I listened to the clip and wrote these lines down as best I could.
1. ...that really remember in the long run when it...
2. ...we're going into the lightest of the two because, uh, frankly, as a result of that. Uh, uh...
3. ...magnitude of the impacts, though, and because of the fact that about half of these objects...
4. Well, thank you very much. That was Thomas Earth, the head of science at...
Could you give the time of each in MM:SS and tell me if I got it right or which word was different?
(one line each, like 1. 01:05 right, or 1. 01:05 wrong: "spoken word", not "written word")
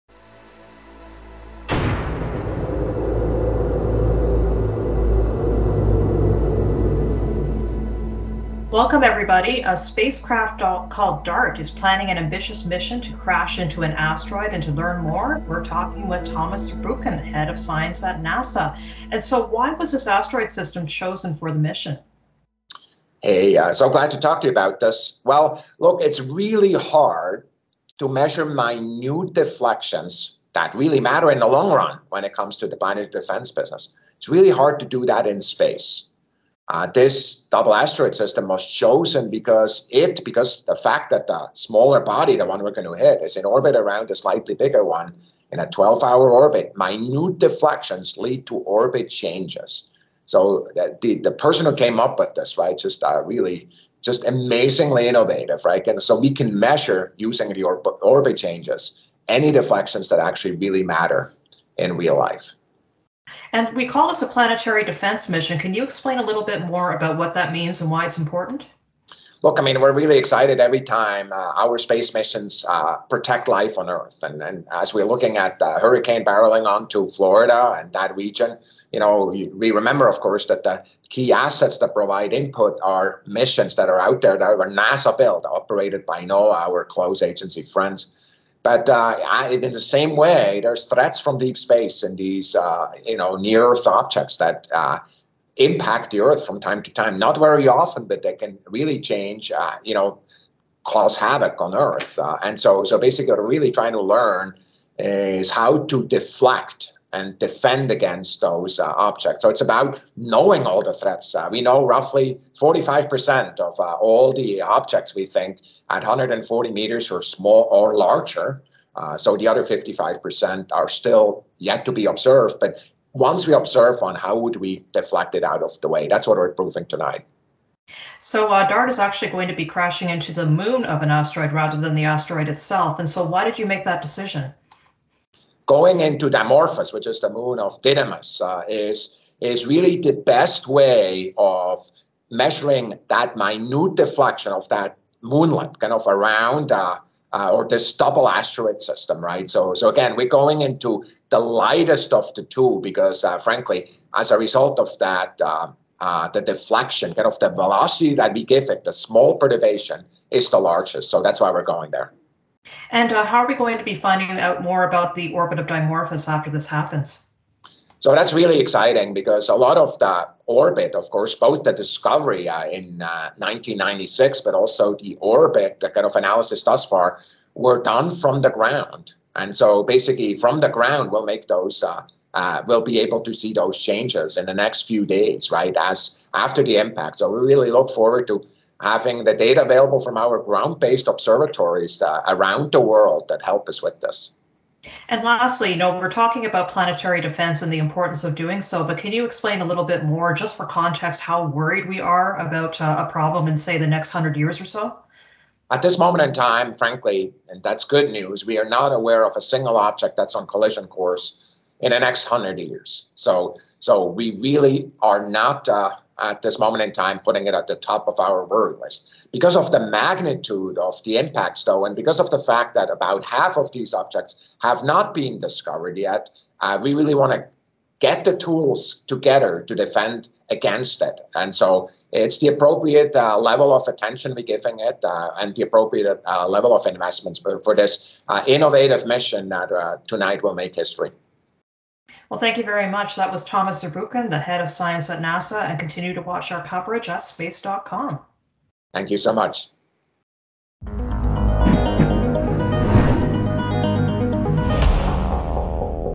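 1. 00:30 wrong: "matter", not "remember"
2. 02:30 right
3. 03:39 right
4. 04:02 wrong: "Zurbuchen", not "Earth".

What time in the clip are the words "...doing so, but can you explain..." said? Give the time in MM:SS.
03:18.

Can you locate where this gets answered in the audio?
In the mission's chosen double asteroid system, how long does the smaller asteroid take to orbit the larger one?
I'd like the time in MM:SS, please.
00:45.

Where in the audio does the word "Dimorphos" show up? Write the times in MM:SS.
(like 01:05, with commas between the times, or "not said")
02:16, 02:45.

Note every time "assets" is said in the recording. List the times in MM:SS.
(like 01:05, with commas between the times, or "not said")
01:21.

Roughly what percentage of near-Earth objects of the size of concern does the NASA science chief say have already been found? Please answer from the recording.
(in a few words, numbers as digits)
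45%.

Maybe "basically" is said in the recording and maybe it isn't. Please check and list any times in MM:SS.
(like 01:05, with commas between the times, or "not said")
01:42, 02:59.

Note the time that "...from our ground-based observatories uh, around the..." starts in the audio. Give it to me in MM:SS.
03:10.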